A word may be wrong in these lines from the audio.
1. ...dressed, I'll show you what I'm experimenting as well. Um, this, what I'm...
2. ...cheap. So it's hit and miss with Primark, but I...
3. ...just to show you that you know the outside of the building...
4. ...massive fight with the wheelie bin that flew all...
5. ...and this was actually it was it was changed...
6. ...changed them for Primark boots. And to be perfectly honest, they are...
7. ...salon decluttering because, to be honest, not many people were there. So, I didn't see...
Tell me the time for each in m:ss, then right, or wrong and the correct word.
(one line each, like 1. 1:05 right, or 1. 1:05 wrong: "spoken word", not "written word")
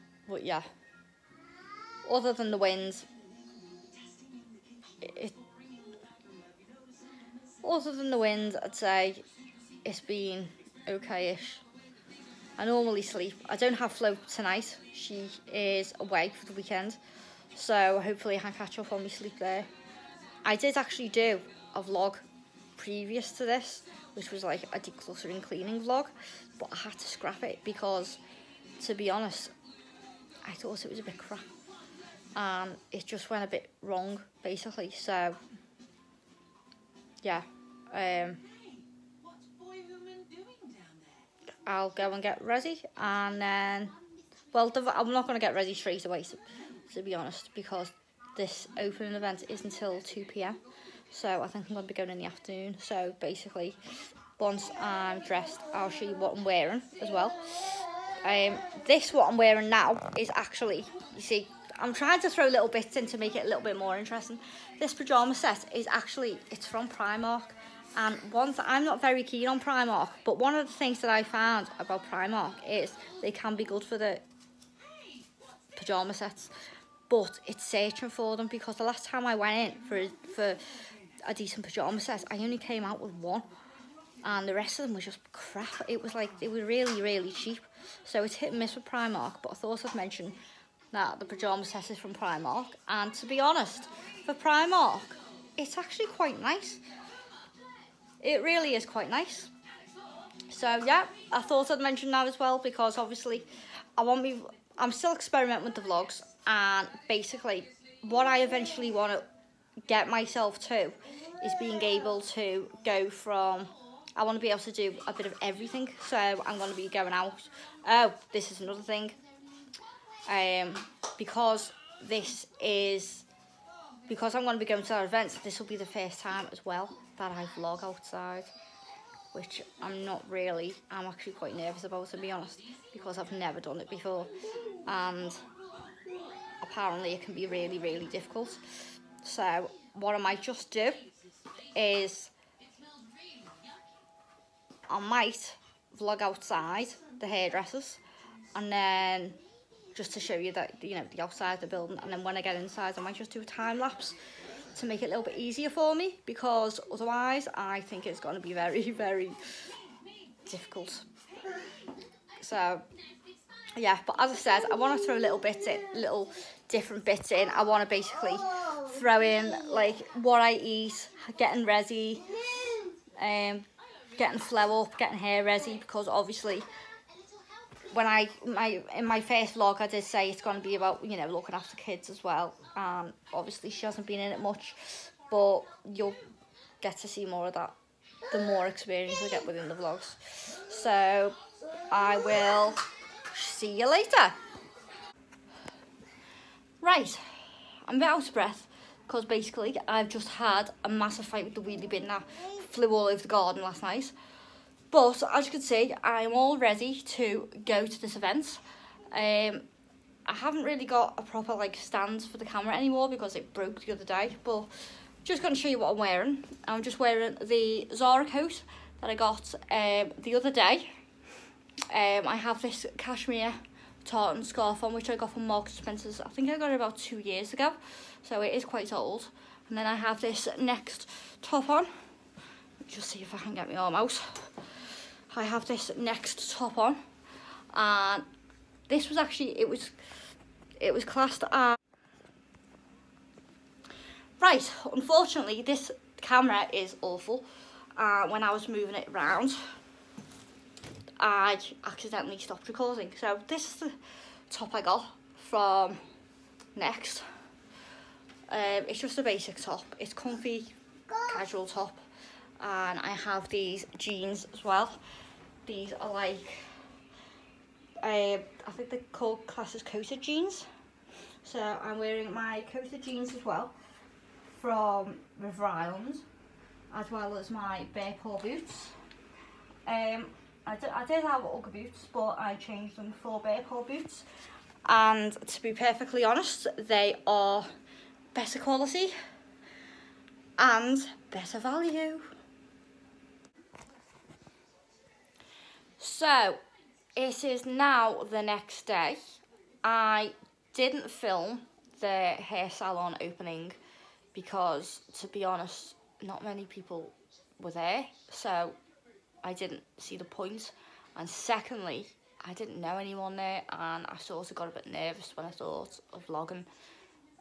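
1. 0:55 wrong: "wearing", not "experimenting"
2. 1:27 right
3. 2:29 right
4. 3:20 right
5. 3:57 wrong: "classed", not "changed"
6. 4:42 wrong: "Bearpaw", not "Primark"
7. 5:02 wrong: "opening", not "decluttering".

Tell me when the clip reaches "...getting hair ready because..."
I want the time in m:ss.
2:54.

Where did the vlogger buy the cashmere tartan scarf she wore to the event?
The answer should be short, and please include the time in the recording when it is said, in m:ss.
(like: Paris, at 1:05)
Marks & Spencer, at 3:45.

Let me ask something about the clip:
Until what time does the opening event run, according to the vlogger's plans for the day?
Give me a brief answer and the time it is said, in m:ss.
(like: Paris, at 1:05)
2pm, at 0:49.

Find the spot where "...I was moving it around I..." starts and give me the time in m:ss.
4:08.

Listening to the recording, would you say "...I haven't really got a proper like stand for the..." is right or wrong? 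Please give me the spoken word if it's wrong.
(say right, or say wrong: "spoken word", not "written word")
right.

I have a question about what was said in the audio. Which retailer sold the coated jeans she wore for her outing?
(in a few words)
River Island.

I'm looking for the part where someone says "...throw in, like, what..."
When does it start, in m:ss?
2:48.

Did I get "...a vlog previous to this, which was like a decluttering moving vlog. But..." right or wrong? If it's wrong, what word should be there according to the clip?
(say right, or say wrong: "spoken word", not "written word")
wrong: "cleaning", not "moving".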